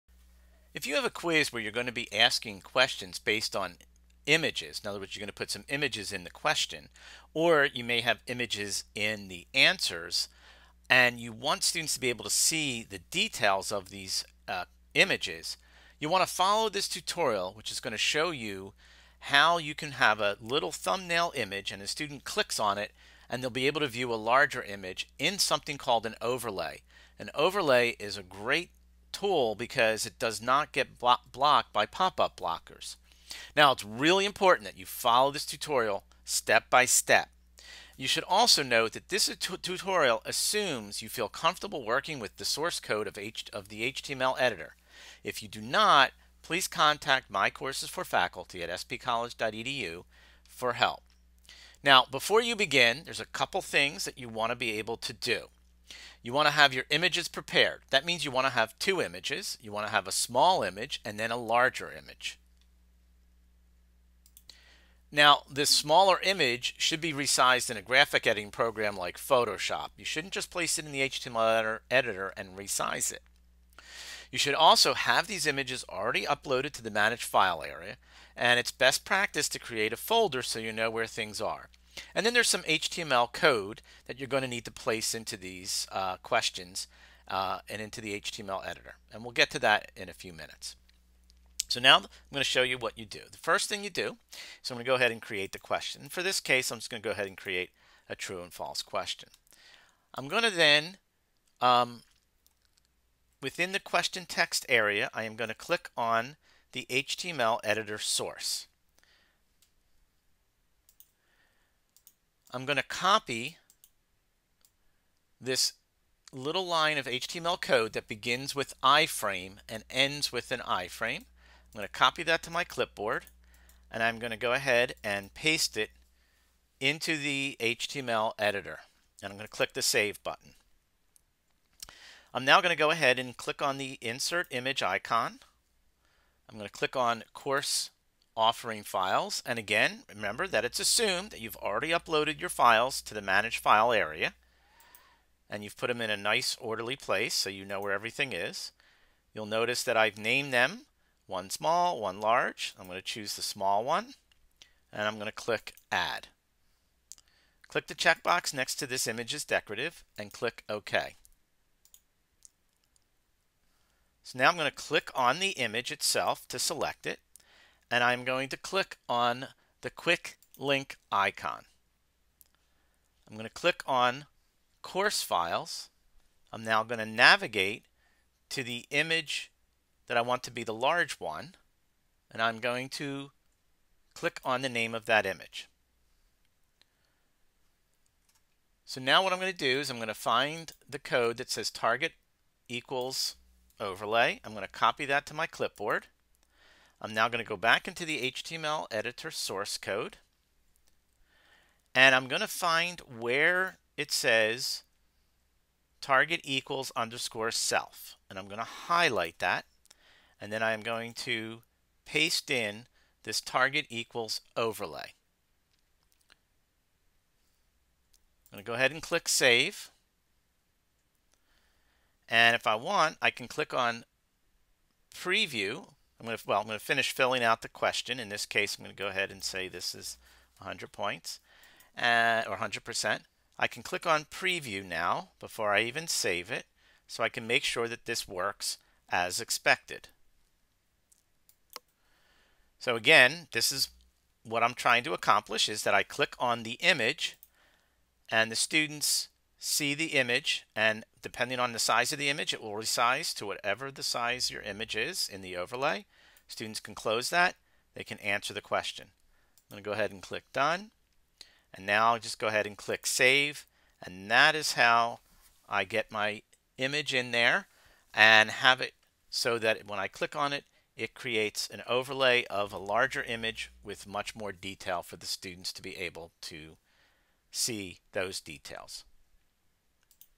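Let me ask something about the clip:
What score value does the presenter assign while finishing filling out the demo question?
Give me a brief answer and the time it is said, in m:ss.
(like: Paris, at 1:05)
100 points, at 3:50.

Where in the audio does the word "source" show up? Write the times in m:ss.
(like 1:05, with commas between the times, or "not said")
0:42, 1:47, 3:19.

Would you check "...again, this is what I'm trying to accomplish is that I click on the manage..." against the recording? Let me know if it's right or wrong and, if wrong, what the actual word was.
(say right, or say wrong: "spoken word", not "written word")
wrong: "image", not "manage".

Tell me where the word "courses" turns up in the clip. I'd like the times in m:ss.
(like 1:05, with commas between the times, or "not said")
0:47, 2:17, 2:54.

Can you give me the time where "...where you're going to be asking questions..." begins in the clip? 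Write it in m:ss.
0:01.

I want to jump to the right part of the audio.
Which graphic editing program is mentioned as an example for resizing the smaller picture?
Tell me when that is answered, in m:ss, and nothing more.
1:09.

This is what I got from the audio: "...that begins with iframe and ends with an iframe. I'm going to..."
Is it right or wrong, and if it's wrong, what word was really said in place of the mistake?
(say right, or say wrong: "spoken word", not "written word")
right.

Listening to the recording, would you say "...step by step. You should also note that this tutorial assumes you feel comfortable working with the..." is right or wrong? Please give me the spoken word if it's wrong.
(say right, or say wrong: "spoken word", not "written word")
right.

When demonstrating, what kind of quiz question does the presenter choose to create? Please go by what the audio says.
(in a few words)
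true and false.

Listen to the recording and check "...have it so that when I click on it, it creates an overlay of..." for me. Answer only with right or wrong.
right.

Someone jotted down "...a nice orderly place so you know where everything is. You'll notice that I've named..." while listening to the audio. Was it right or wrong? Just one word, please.
right.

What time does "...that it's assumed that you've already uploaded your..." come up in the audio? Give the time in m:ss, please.
2:20.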